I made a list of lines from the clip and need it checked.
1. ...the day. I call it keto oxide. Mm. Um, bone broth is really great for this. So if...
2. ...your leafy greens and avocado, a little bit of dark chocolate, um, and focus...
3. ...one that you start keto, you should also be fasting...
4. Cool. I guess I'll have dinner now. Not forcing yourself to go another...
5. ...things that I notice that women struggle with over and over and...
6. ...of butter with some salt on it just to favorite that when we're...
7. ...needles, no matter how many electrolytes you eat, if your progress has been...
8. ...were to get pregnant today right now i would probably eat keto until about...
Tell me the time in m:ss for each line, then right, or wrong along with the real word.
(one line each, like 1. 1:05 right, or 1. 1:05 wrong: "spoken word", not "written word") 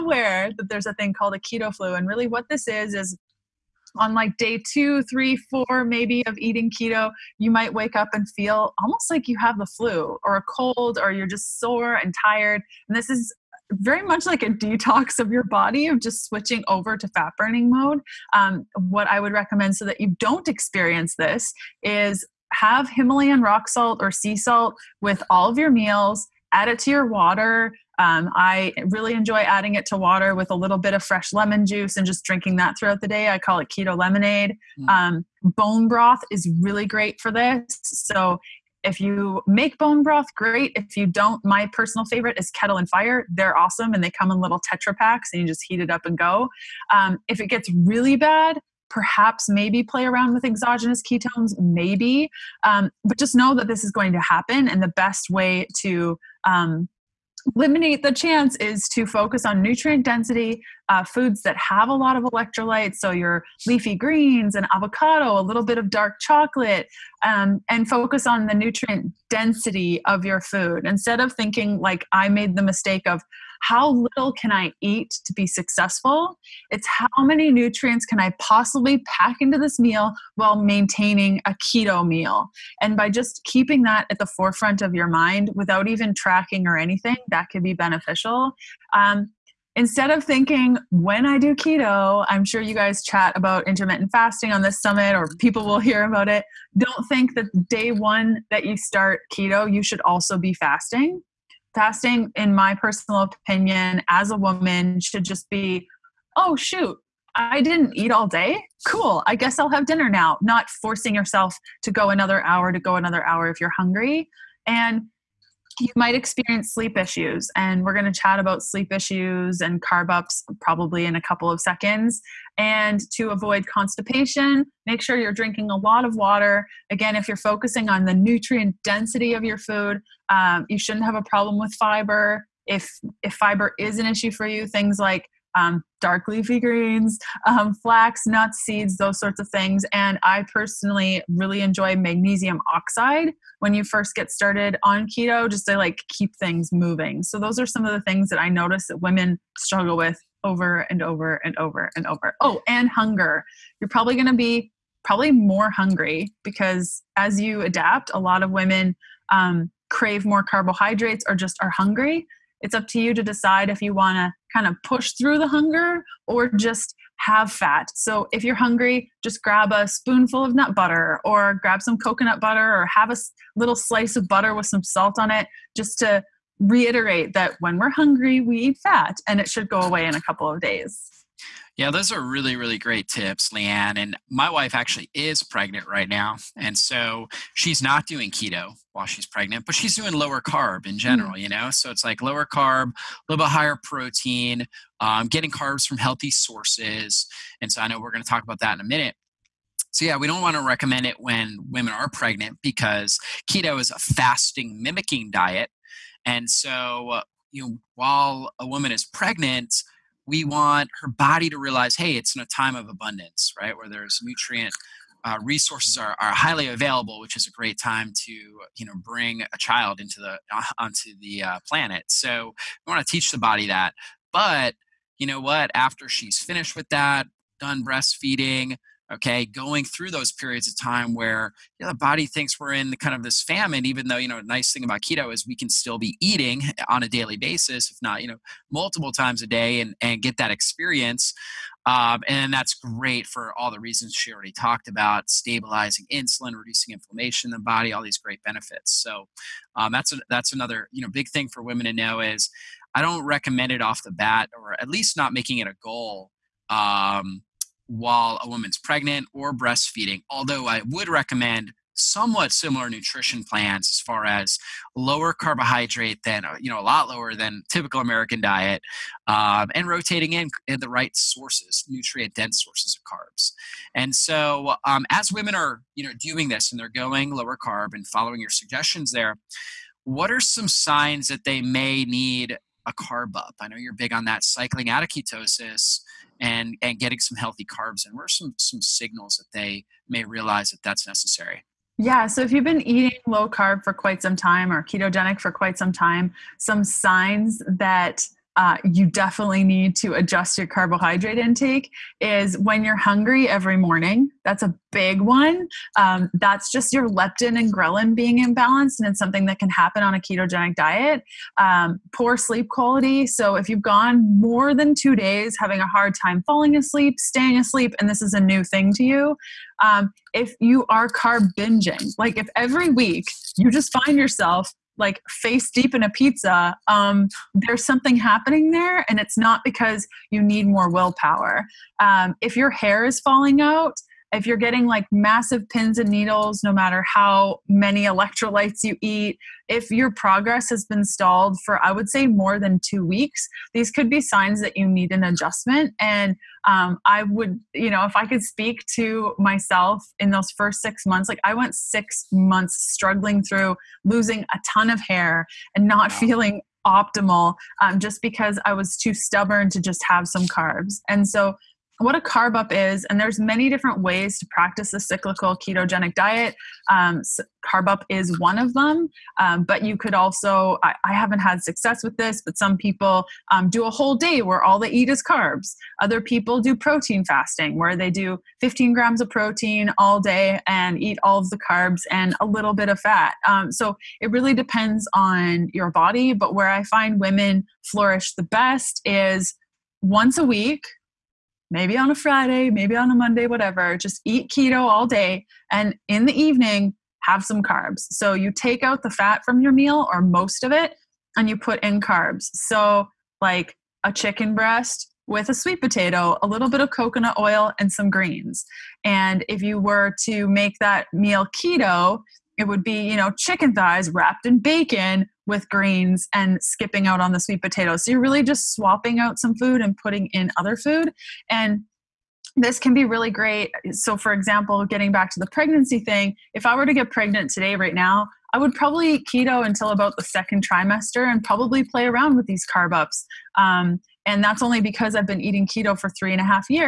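1. 0:32 wrong: "lemonade", not "oxide"
2. 1:03 right
3. 1:37 right
4. 1:48 right
5. 2:28 right
6. 2:54 wrong: "reiterate", not "favorite"
7. 5:36 right
8. 7:06 right.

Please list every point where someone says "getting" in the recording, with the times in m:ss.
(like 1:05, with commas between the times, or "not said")
3:15, 4:46, 5:34, 7:04.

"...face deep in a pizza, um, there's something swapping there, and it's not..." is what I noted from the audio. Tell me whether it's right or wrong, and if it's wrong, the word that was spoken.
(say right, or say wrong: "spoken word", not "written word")
wrong: "happening", not "swapping".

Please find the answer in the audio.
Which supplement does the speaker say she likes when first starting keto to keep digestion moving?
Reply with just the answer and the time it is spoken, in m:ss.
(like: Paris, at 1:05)
magnesium oxide, at 2:21.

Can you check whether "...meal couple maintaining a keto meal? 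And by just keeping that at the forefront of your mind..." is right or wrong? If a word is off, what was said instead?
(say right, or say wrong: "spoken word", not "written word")
wrong: "while", not "couple".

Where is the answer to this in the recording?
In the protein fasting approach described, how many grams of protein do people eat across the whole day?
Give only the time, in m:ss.
6:18.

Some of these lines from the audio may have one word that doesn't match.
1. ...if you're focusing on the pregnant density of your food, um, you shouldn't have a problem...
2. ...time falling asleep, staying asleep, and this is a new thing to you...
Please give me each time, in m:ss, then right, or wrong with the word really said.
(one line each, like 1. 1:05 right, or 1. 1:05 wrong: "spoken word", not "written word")
1. 2:07 wrong: "nutrient", not "pregnant"
2. 5:16 right.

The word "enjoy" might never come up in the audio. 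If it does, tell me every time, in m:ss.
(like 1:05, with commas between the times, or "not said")
0:29, 2:21.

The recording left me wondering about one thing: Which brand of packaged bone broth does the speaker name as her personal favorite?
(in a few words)
Kettle and Fire.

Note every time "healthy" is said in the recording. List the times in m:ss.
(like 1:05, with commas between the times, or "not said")
3:15, 4:47.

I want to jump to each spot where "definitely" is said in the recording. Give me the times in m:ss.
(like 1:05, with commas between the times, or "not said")
4:59.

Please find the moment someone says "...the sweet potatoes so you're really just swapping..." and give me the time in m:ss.
6:57.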